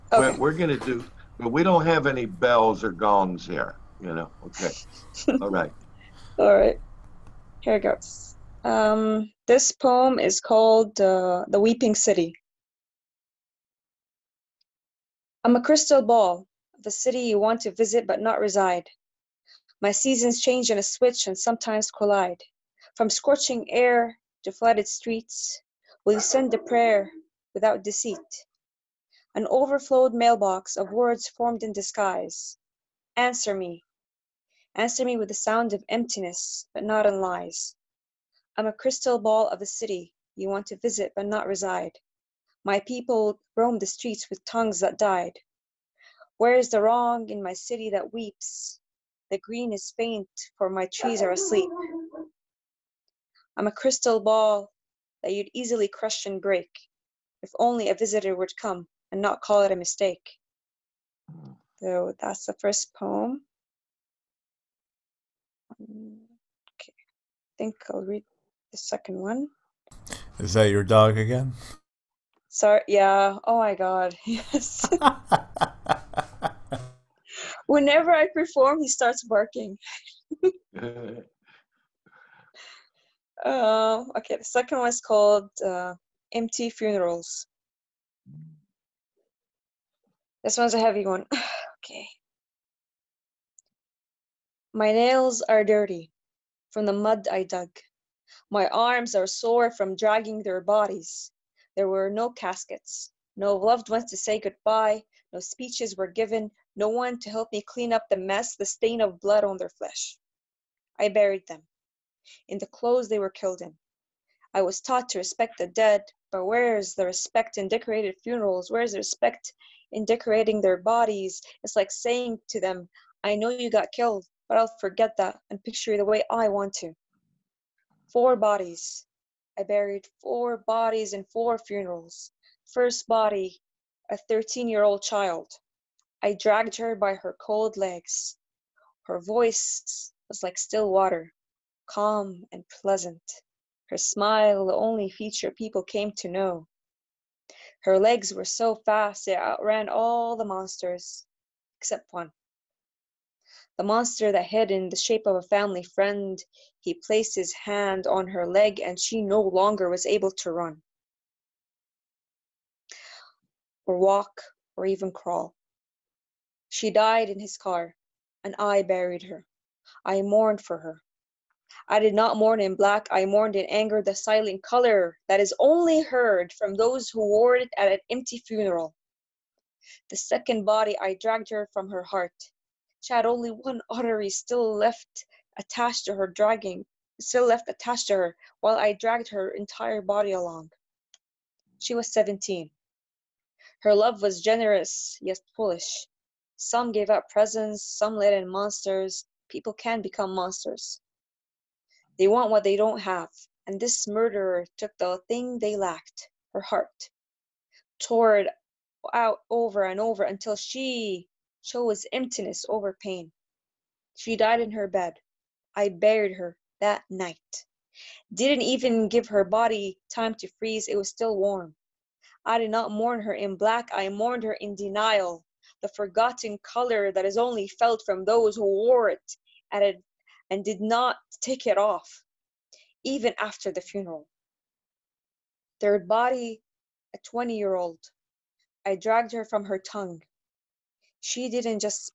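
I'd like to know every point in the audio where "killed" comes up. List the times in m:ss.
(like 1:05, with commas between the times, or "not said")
1:53, 2:03.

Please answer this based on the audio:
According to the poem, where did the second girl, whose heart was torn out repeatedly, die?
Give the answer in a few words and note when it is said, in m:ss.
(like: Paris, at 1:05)
In her bed, at 3:34.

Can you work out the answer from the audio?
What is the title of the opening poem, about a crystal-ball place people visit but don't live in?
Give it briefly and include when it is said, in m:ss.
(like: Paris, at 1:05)
The Weeping City, at 0:11.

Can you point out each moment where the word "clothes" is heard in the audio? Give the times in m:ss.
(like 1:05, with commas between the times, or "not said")
1:52.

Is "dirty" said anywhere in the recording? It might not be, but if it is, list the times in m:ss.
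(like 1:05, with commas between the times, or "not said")
1:35.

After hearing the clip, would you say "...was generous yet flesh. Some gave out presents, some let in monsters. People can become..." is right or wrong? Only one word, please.
wrong.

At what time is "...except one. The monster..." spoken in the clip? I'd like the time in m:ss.
2:31.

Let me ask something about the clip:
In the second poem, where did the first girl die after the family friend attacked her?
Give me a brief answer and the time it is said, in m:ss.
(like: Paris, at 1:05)
In his car, at 2:47.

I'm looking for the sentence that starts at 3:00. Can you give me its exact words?
The second body I dragged her from her heart.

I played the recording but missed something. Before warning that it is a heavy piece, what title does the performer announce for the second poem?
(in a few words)
Empty Funerals.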